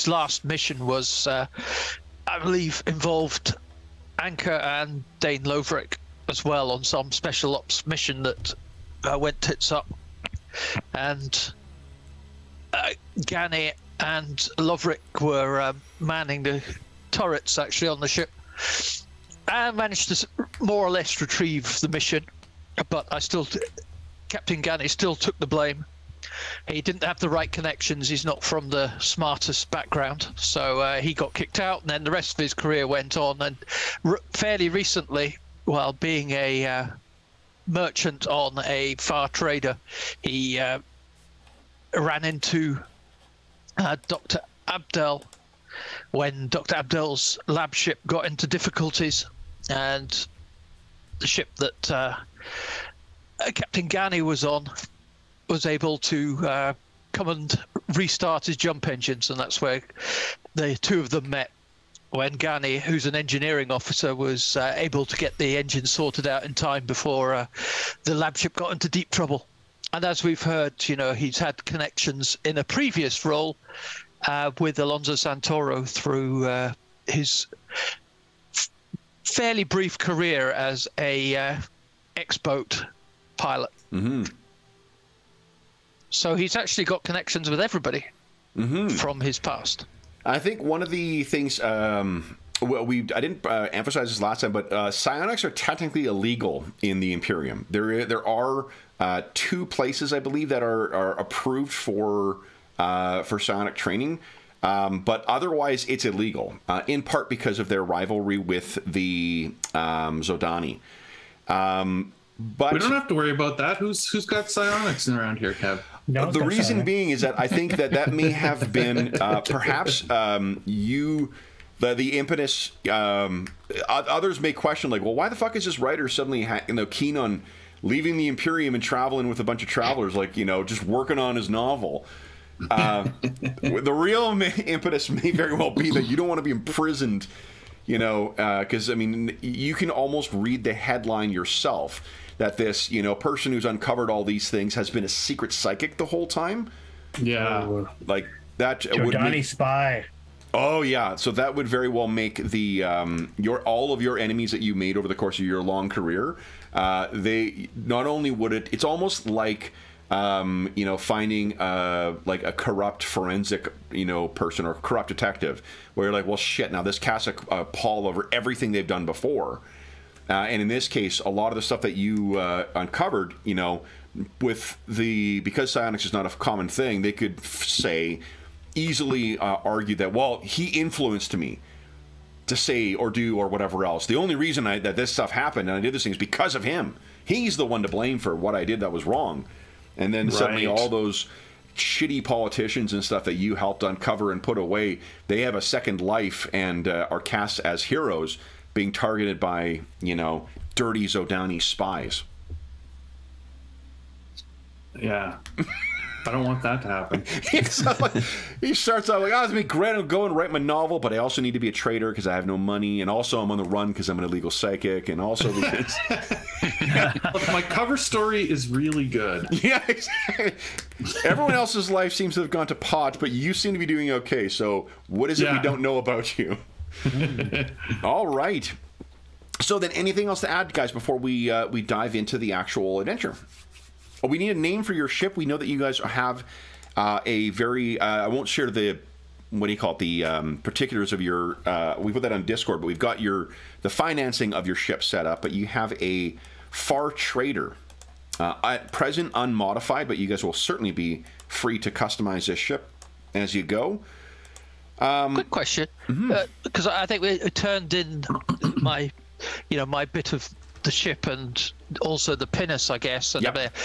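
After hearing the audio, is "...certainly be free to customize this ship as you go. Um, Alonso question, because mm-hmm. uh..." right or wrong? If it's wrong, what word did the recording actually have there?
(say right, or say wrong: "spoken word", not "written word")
wrong: "Quick", not "Alonso".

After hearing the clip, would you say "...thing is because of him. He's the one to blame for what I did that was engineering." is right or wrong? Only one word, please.
wrong.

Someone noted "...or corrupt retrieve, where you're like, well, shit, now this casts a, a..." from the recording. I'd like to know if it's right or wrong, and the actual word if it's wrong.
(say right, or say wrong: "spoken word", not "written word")
wrong: "detective", not "retrieve".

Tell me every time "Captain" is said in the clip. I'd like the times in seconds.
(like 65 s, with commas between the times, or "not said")
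24 s, 53 s.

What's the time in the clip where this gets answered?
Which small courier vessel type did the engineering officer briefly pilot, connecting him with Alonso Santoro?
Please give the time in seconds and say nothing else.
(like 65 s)
82 s.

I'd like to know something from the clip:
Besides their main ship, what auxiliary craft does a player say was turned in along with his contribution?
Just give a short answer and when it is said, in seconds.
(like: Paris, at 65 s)
pinnace, at 262 s.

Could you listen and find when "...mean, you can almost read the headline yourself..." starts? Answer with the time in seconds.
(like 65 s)
138 s.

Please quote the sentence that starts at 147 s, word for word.
Yeah, like that Zhodani would make...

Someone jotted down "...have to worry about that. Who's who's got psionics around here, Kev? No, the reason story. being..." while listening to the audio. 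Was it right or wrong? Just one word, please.
wrong.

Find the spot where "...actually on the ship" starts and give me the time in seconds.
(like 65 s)
17 s.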